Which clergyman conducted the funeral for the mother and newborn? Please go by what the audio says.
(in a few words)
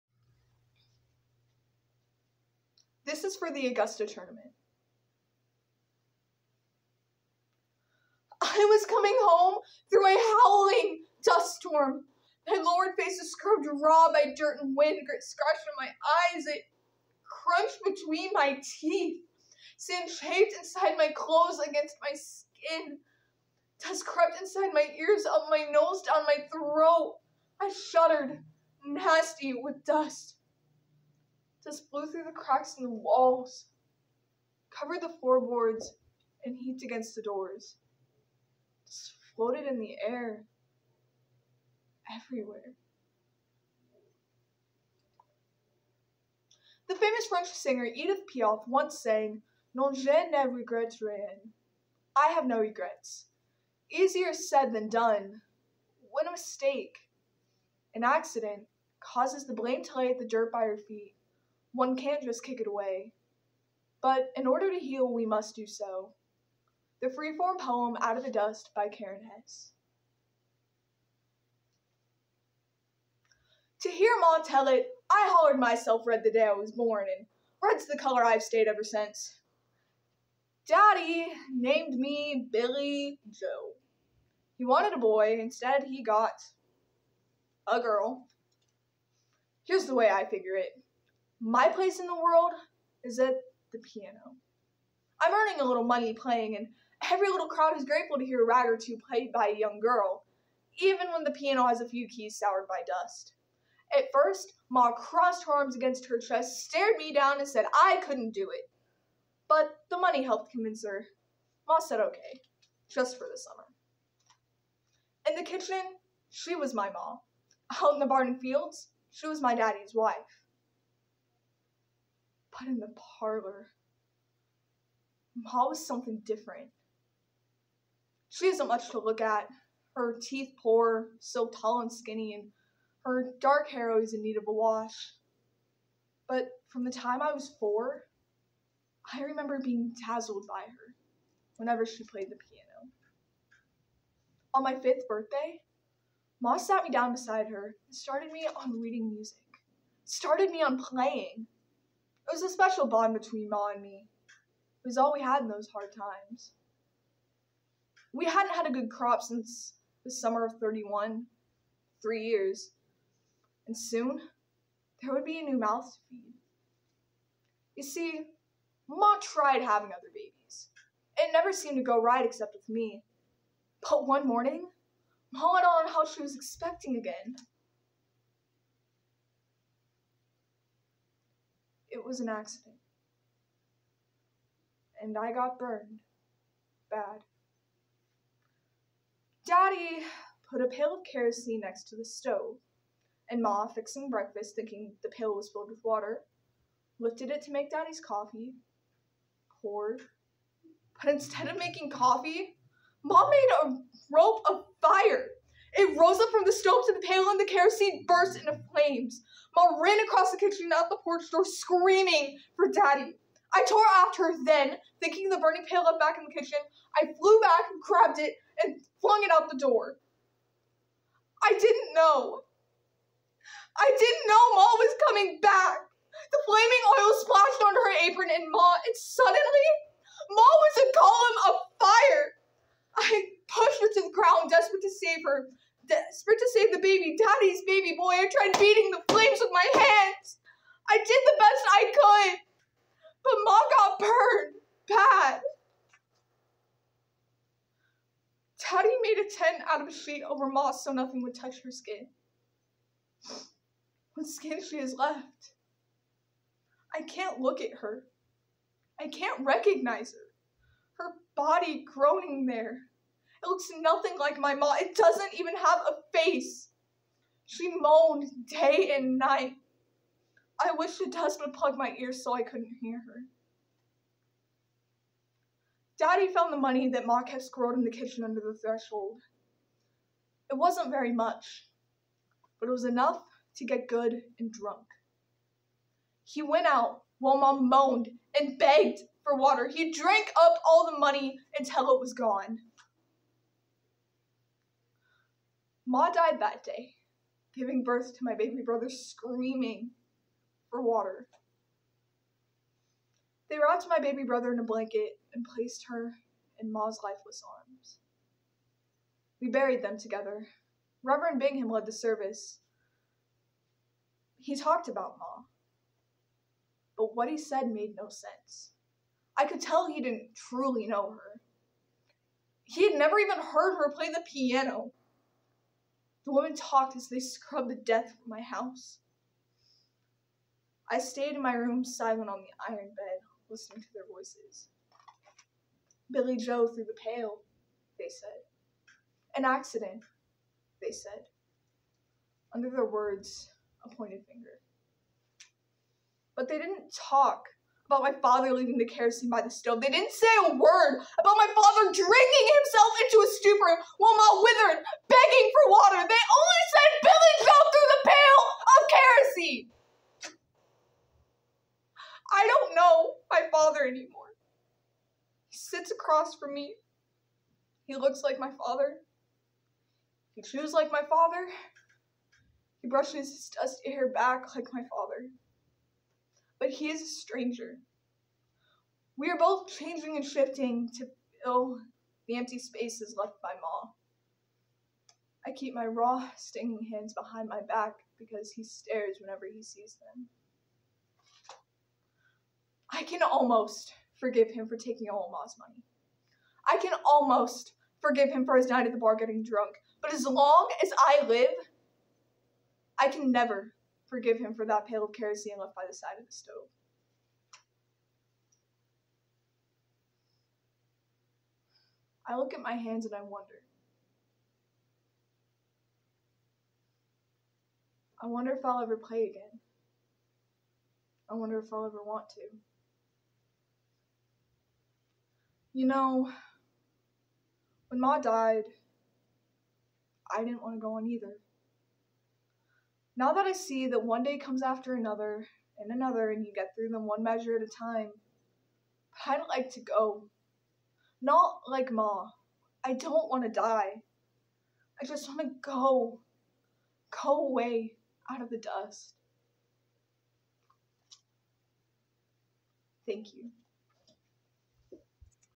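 Reverend Bingham.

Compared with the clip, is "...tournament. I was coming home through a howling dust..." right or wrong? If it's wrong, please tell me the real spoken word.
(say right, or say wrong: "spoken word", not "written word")
right.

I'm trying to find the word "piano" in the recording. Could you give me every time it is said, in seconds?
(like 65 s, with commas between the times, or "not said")
93 s, 101 s, 142 s, 324 s.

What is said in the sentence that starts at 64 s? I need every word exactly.
But in order to heal, we must do so.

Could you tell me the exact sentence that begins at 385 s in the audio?
I keep my raw, stinging hands behind my back because he stares whenever he sees them.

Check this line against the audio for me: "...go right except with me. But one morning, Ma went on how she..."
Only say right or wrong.
right.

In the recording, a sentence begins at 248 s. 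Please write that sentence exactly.
Daddy made a tent out of a sheet over moss so nothing would touch her skin.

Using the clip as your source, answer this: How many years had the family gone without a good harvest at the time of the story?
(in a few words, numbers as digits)
3.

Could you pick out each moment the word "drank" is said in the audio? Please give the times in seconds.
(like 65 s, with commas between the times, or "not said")
289 s.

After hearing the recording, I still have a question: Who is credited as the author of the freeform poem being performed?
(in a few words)
Karen Hesse.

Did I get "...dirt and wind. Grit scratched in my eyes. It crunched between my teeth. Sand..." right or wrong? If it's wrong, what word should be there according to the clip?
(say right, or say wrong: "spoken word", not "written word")
right.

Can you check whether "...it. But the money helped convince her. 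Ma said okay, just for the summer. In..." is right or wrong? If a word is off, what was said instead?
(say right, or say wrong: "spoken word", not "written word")
right.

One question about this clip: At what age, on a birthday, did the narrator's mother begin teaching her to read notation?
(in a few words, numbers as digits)
5.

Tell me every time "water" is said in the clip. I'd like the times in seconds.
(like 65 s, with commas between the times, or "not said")
195 s, 289 s, 300 s, 355 s.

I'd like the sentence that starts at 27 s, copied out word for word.
I shuddered, nasty with dust just blew through the cracks in the walls, covered the floorboards, and heaped against the doors.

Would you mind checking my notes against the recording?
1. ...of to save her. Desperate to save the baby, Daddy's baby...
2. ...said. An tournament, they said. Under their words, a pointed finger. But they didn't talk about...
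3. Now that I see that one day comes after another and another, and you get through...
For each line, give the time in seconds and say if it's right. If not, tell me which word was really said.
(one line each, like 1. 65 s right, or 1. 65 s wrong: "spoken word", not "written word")
1. 231 s right
2. 338 s wrong: "accident", not "tournament"
3. 433 s right.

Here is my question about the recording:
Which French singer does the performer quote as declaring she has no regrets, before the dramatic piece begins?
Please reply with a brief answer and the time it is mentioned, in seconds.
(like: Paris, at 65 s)
Edith Piaf, at 47 s.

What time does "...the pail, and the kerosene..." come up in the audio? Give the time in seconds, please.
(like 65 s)
206 s.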